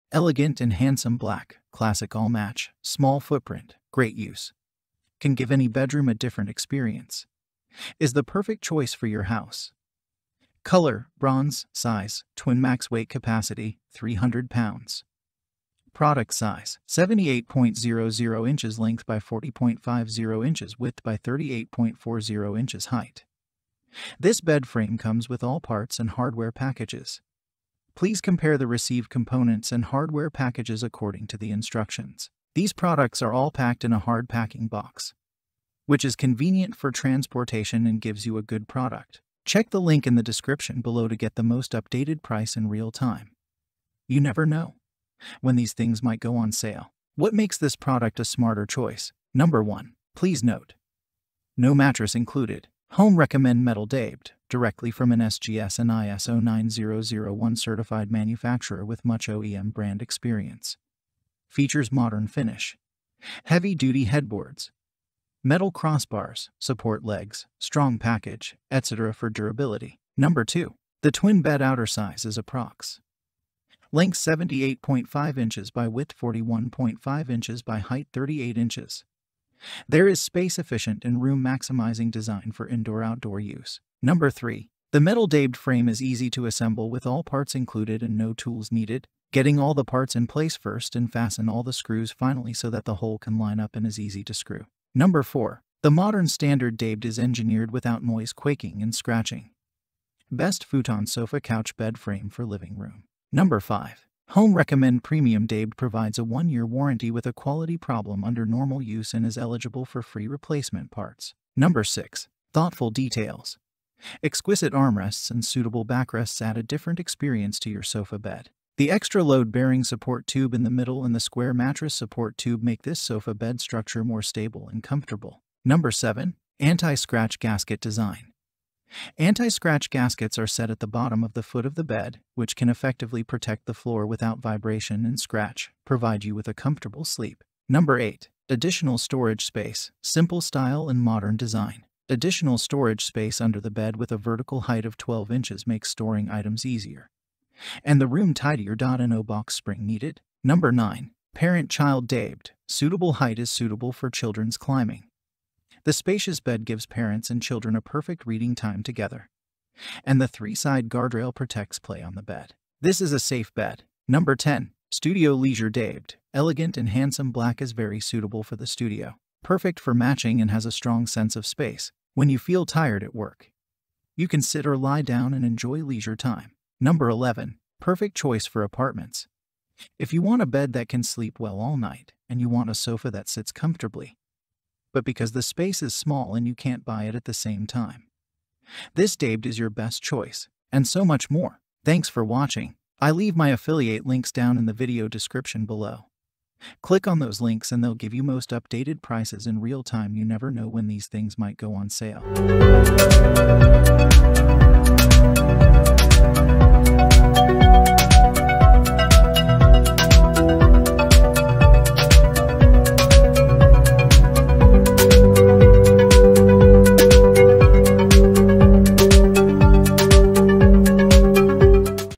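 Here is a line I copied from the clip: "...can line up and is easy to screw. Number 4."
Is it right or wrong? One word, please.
right.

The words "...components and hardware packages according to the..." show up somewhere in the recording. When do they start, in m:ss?
0:29.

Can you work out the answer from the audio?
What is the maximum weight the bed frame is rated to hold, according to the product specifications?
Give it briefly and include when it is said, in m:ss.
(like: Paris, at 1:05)
300 pounds, at 0:13.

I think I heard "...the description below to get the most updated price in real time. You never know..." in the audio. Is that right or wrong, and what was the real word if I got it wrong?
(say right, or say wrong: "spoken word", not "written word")
right.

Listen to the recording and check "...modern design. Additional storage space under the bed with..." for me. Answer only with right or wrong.
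right.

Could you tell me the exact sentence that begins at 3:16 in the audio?
Click on those links and they'll give you most updated prices in real time.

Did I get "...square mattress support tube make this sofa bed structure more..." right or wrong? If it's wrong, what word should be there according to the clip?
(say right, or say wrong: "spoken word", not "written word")
right.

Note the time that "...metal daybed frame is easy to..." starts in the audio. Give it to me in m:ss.
1:24.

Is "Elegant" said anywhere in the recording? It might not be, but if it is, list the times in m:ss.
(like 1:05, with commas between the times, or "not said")
0:00, 2:46.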